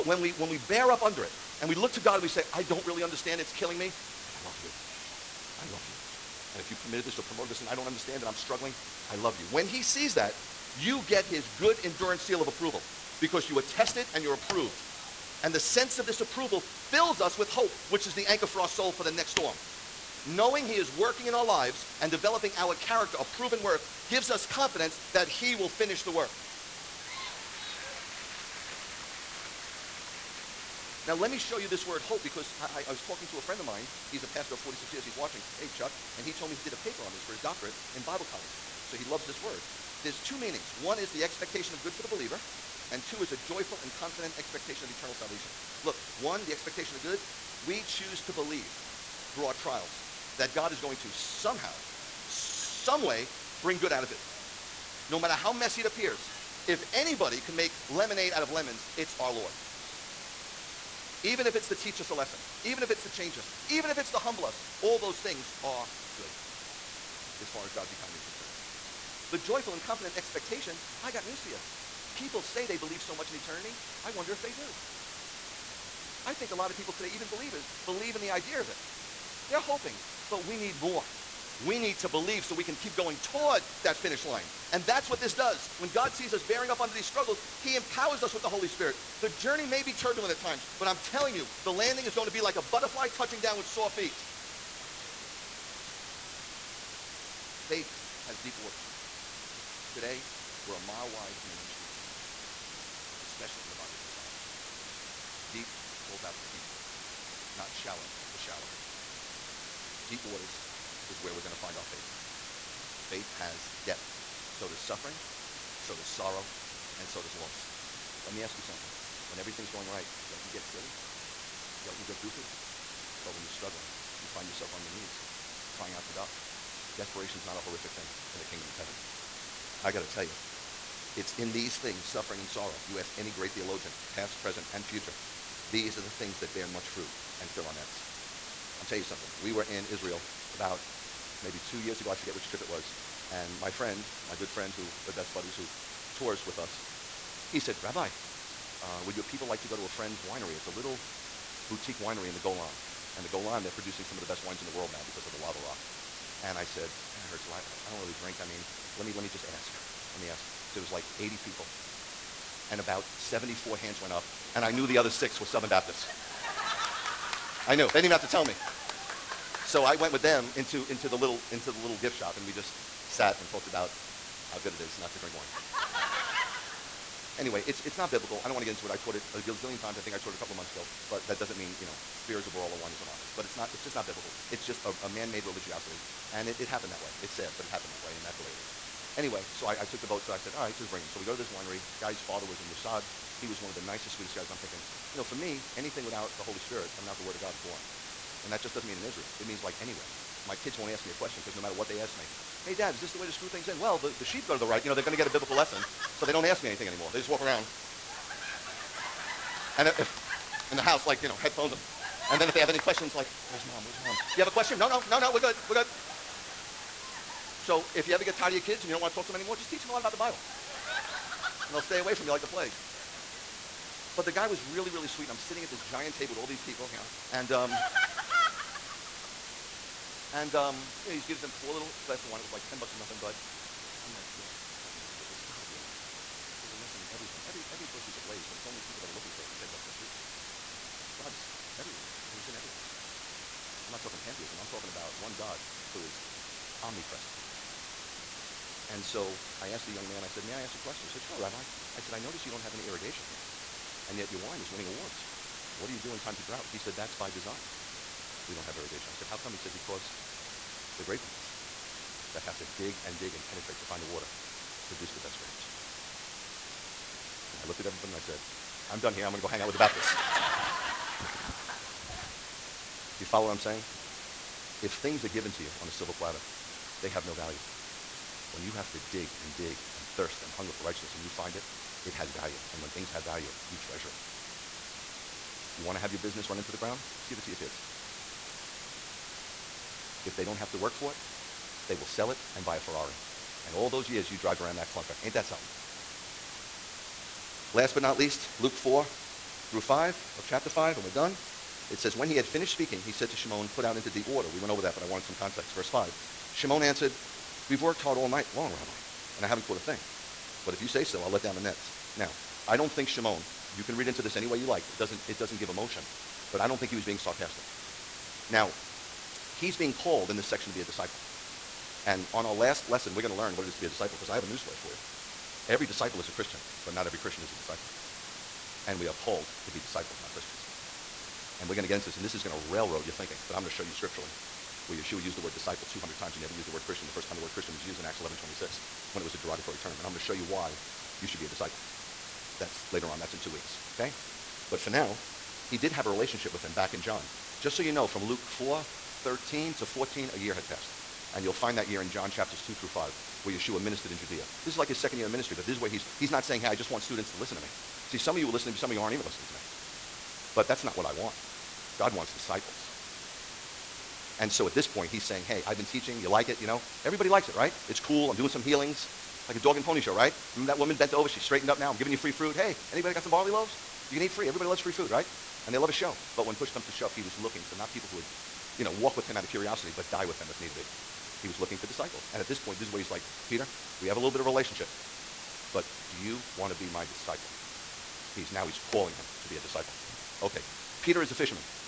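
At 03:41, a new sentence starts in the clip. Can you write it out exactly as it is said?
And they'll stay away from you like the plague.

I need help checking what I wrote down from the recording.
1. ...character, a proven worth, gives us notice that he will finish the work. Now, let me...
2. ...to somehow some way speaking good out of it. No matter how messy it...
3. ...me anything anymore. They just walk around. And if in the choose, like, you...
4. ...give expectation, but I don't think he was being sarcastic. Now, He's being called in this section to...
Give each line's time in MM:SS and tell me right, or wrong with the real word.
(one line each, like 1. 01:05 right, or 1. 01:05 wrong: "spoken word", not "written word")
1. 00:22 wrong: "confidence", not "notice"
2. 00:50 wrong: "bring", not "speaking"
3. 03:26 wrong: "house", not "choose"
4. 05:15 wrong: "emotion", not "expectation".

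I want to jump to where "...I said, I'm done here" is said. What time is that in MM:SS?
04:28.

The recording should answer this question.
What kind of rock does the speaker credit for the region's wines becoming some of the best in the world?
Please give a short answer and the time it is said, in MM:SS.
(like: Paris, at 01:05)
lava rock, at 02:35.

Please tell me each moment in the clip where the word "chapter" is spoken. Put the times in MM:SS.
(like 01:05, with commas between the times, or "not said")
05:00, 05:52.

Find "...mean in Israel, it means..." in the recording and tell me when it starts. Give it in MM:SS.
03:18.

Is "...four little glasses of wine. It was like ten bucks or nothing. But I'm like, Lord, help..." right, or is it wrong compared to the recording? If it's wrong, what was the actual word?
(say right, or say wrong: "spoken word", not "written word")
right.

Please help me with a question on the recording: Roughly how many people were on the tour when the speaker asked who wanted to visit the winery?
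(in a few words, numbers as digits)
80.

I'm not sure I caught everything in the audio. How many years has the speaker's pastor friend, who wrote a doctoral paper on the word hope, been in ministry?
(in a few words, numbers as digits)
46.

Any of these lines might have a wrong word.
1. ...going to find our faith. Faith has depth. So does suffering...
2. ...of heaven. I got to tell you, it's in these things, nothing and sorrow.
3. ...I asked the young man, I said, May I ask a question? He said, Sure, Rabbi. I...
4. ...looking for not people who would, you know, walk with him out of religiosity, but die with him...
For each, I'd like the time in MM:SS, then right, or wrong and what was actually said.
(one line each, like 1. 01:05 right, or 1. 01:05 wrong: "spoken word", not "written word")
1. 01:51 right
2. 02:08 wrong: "suffering", not "nothing"
3. 04:09 right
4. 06:17 wrong: "curiosity", not "religiosity".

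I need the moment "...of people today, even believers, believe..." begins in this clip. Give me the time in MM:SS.
01:16.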